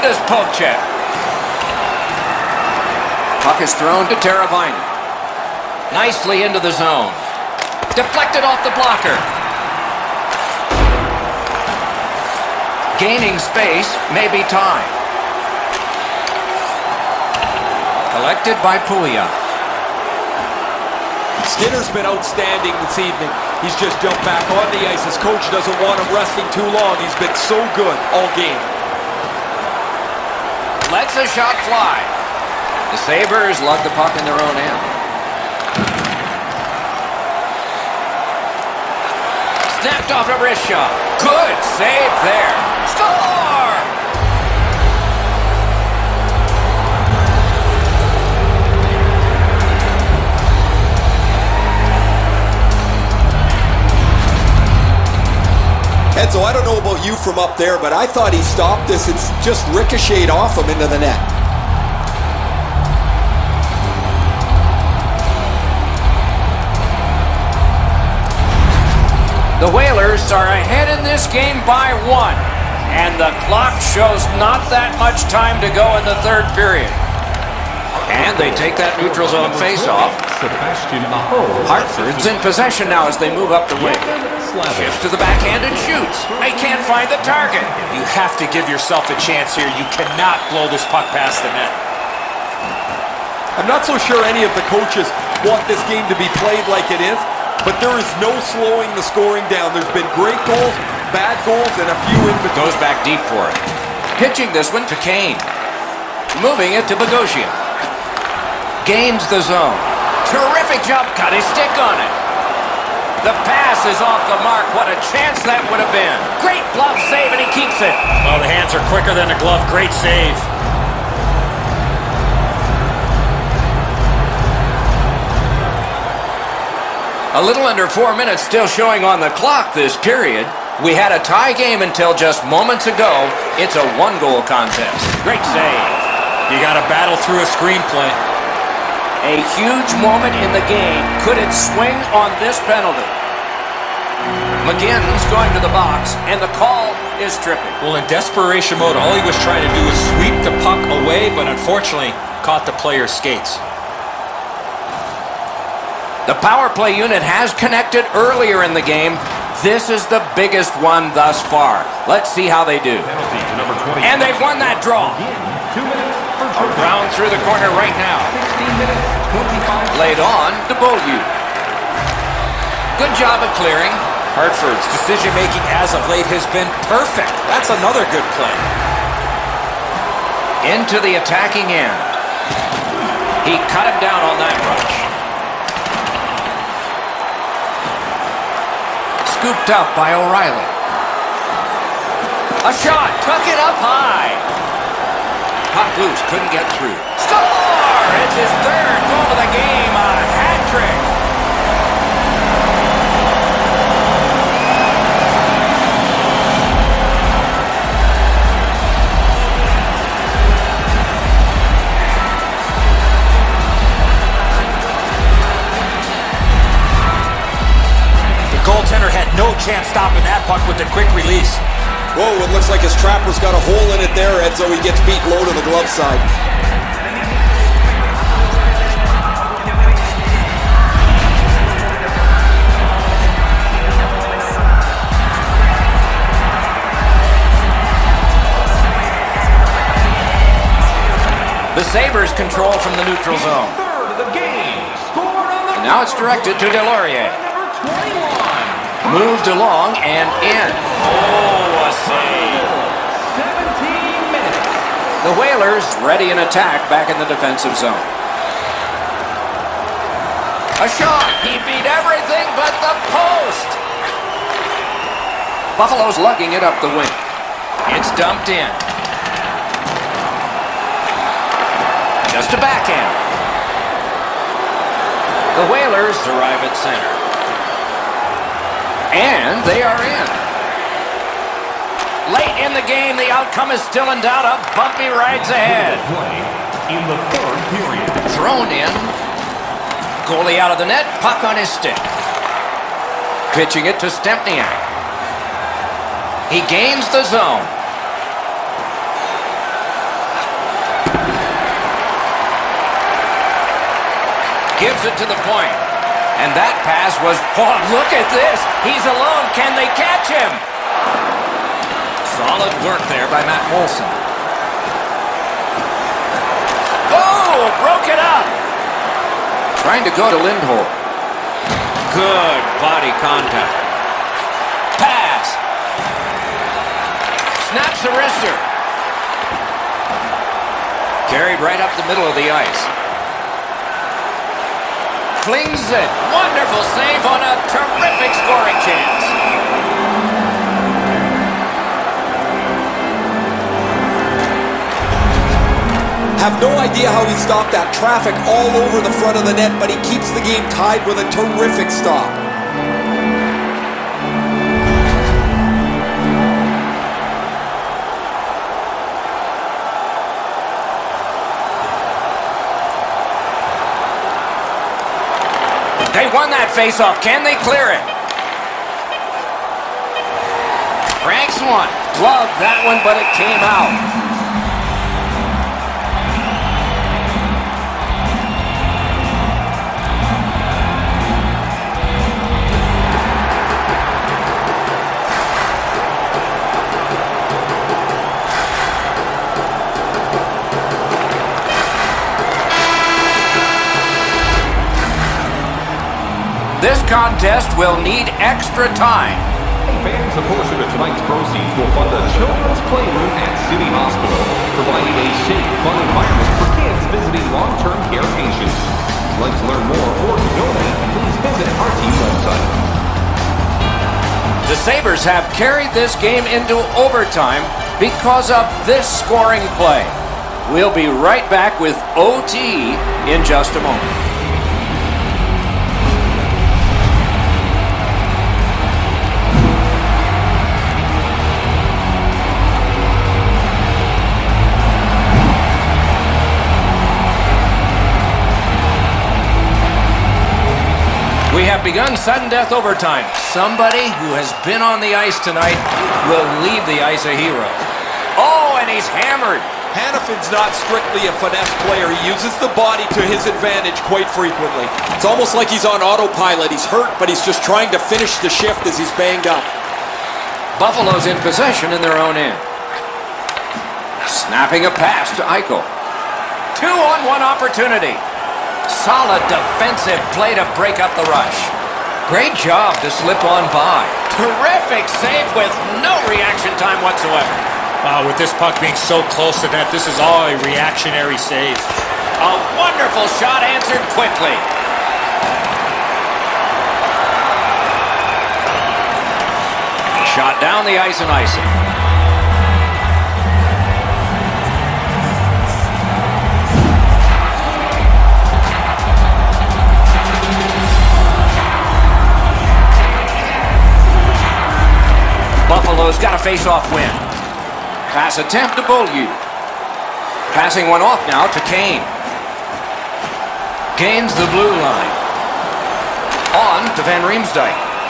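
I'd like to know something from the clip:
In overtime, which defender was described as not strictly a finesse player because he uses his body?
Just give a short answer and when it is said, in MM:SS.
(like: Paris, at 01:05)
Hanifin, at 07:29.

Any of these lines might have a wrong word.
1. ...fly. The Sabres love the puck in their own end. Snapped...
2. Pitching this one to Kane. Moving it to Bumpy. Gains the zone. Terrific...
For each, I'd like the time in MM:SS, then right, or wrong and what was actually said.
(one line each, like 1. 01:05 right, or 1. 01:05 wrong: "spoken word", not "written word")
1. 00:31 right
2. 01:44 wrong: "Bogosian", not "Bumpy".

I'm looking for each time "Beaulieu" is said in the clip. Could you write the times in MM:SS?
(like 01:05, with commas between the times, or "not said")
02:50, 08:28.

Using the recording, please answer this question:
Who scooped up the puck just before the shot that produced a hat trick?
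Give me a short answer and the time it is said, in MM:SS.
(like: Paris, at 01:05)
O'Reilly, at 03:10.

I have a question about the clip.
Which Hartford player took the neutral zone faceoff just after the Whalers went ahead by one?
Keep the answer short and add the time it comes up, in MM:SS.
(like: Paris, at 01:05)
Sebastian Aho, at 01:20.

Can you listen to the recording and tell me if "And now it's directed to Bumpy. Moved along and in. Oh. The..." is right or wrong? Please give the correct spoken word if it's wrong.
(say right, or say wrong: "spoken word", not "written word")
wrong: "Delorier", not "Bumpy".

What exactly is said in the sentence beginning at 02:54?
Hartford's decision-making as of late has been perfect.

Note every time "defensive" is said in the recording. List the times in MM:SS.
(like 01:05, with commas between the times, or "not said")
04:17, 07:49.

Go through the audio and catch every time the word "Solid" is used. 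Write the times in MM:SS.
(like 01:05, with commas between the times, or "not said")
05:12, 07:48.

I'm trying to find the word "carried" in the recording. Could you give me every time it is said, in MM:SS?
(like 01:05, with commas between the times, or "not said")
05:31, 06:55.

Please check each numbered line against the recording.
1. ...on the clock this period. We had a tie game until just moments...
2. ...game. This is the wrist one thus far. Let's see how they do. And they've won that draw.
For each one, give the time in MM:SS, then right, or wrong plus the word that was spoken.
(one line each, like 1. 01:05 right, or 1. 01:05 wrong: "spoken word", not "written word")
1. 02:09 right
2. 02:38 wrong: "biggest", not "wrist".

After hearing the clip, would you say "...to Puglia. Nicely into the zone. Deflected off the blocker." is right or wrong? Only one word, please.
wrong.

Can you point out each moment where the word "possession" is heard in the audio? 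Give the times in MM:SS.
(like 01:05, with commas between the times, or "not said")
01:22, 07:41.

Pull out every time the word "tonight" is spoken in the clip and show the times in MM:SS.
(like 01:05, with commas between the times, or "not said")
06:40, 07:25.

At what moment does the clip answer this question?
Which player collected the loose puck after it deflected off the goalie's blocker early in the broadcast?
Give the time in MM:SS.
00:18.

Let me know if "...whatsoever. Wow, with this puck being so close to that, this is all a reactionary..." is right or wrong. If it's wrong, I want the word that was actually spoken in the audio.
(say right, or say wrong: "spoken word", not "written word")
right.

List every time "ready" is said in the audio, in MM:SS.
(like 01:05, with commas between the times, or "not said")
04:16.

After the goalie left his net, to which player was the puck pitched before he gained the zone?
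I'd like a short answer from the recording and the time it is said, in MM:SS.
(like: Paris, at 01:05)
Stempniak, at 04:54.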